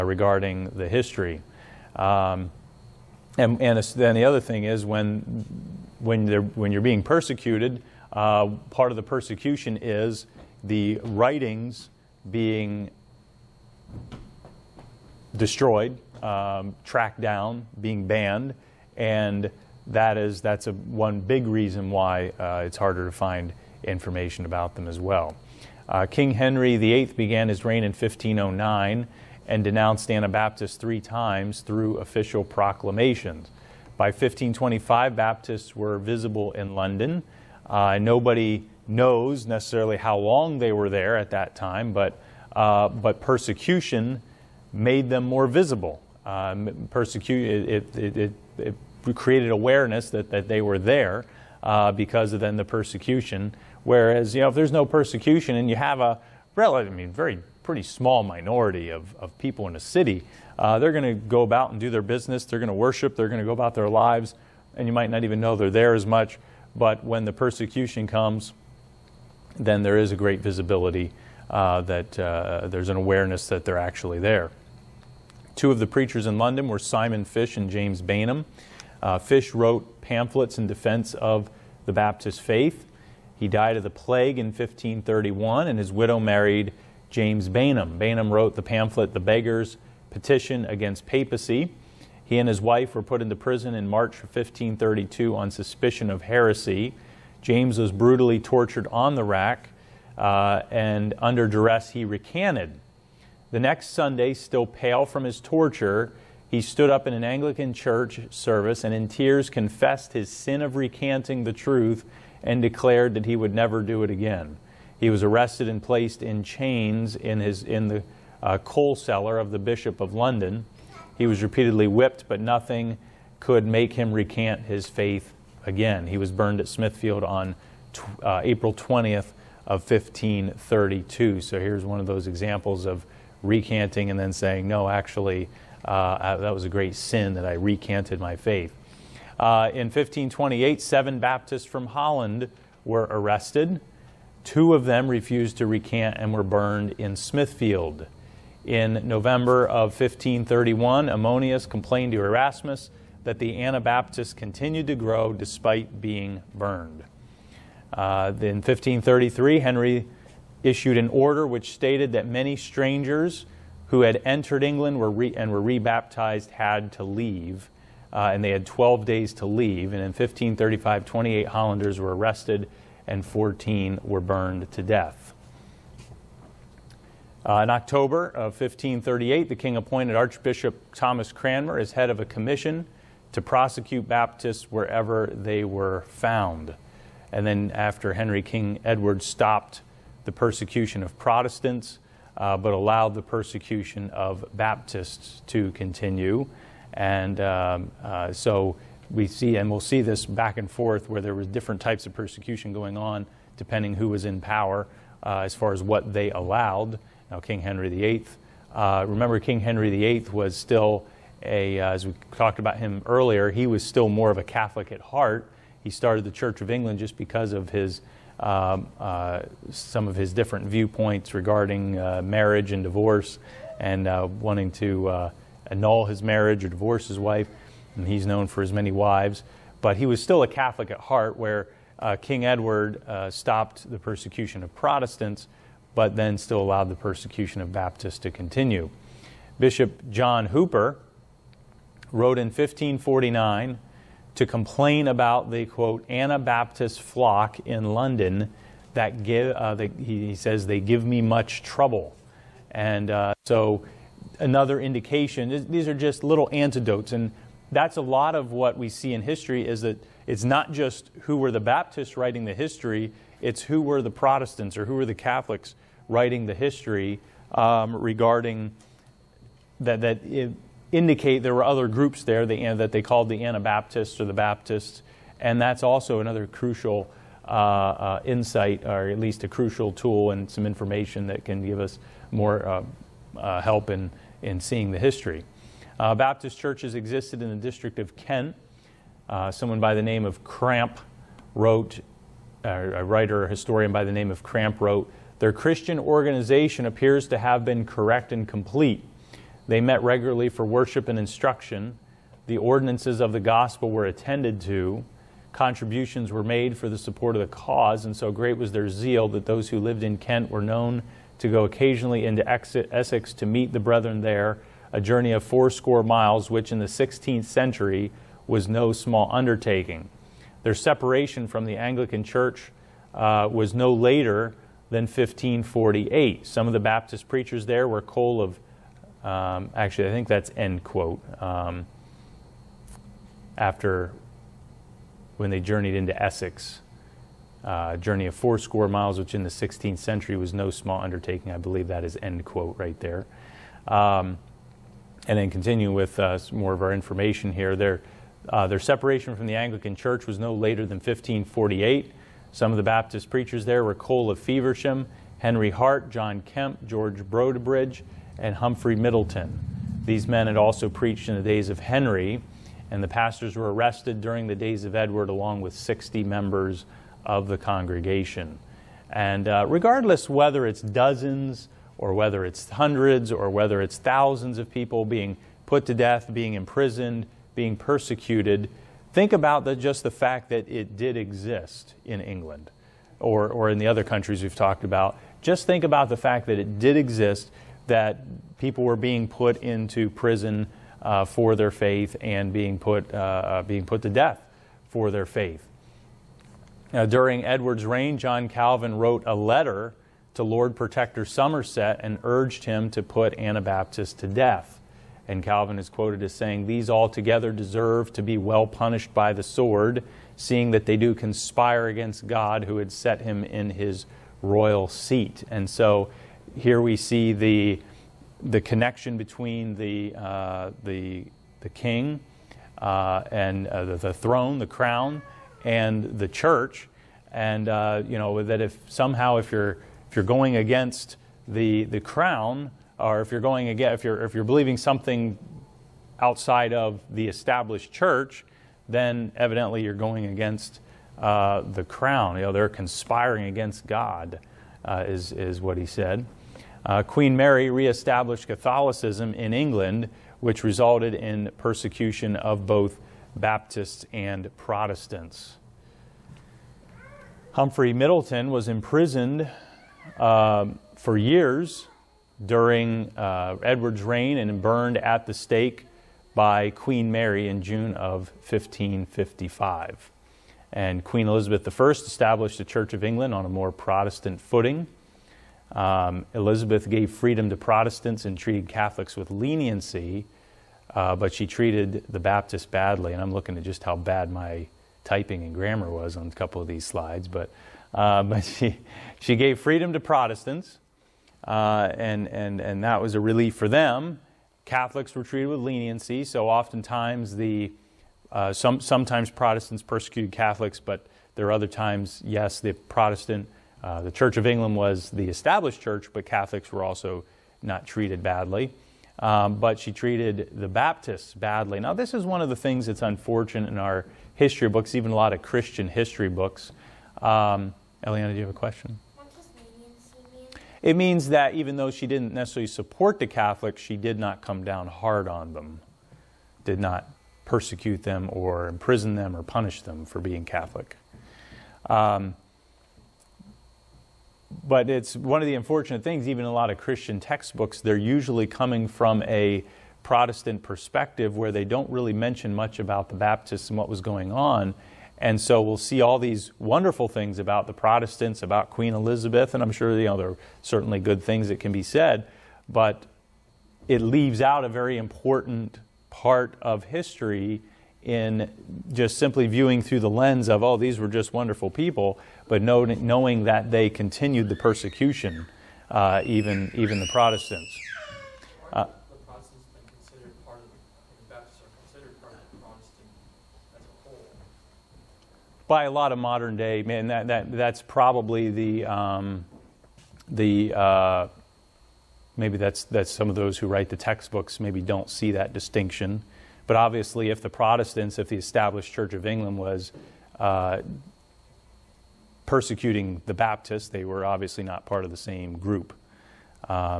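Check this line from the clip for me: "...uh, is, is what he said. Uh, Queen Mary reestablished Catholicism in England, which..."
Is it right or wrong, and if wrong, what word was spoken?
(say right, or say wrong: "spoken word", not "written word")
right.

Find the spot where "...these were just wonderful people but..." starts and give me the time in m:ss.
9:20.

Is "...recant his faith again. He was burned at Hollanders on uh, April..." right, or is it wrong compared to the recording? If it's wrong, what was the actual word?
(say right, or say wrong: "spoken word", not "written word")
wrong: "Smithfield", not "Hollanders".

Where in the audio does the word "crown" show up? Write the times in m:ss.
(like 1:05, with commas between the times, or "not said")
7:04, 7:11, 7:21.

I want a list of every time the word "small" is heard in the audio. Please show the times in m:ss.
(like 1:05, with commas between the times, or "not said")
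0:57, 5:18, 5:40.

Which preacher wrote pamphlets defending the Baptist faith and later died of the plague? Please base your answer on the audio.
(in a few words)
Simon Fish.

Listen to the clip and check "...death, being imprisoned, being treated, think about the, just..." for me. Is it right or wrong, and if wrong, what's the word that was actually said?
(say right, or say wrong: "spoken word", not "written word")
wrong: "persecuted", not "treated".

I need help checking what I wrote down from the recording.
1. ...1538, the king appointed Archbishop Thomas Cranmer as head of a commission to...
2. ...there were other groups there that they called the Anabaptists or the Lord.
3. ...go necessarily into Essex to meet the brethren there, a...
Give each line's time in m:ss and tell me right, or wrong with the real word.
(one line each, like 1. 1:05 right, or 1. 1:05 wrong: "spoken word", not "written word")
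1. 2:58 right
2. 4:31 wrong: "Baptists", not "Lord"
3. 5:11 wrong: "occasionally", not "necessarily".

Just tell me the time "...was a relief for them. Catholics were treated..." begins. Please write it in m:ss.
8:13.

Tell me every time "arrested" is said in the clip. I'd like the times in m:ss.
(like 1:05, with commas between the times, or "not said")
1:55, 2:23, 2:52, 6:03.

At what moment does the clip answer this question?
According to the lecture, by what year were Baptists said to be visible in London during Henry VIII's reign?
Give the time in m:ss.
0:34.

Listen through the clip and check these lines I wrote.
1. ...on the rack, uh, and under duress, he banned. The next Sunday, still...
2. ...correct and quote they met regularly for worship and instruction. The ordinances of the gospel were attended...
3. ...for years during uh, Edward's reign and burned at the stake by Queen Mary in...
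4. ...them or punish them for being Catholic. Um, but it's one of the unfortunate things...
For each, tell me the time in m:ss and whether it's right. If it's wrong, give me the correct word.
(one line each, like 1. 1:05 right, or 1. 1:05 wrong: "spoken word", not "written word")
1. 1:38 wrong: "recanted", not "banned"
2. 4:57 wrong: "complete", not "quote"
3. 7:40 right
4. 8:49 right.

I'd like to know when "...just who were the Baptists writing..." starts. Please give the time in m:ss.
4:20.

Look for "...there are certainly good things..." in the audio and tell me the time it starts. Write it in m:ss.
9:10.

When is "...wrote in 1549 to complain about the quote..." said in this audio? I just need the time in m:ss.
4:02.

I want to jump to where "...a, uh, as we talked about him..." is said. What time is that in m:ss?
3:31.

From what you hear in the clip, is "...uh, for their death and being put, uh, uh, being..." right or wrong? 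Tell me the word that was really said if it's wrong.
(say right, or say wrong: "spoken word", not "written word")
wrong: "faith", not "death".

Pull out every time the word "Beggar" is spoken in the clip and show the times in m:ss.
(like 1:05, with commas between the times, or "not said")
1:29.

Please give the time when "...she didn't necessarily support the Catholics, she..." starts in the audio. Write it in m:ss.
8:41.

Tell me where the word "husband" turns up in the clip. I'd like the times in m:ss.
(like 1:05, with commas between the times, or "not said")
not said.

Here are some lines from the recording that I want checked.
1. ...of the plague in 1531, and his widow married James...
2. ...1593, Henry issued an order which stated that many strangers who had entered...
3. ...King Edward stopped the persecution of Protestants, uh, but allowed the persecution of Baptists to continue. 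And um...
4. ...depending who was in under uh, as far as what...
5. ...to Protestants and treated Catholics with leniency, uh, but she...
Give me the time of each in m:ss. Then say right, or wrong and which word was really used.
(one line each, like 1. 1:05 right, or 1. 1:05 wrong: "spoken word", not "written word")
1. 1:23 right
2. 2:38 wrong: "1533", not "1593"
3. 3:08 right
4. 3:23 wrong: "power", not "under"
5. 7:57 right.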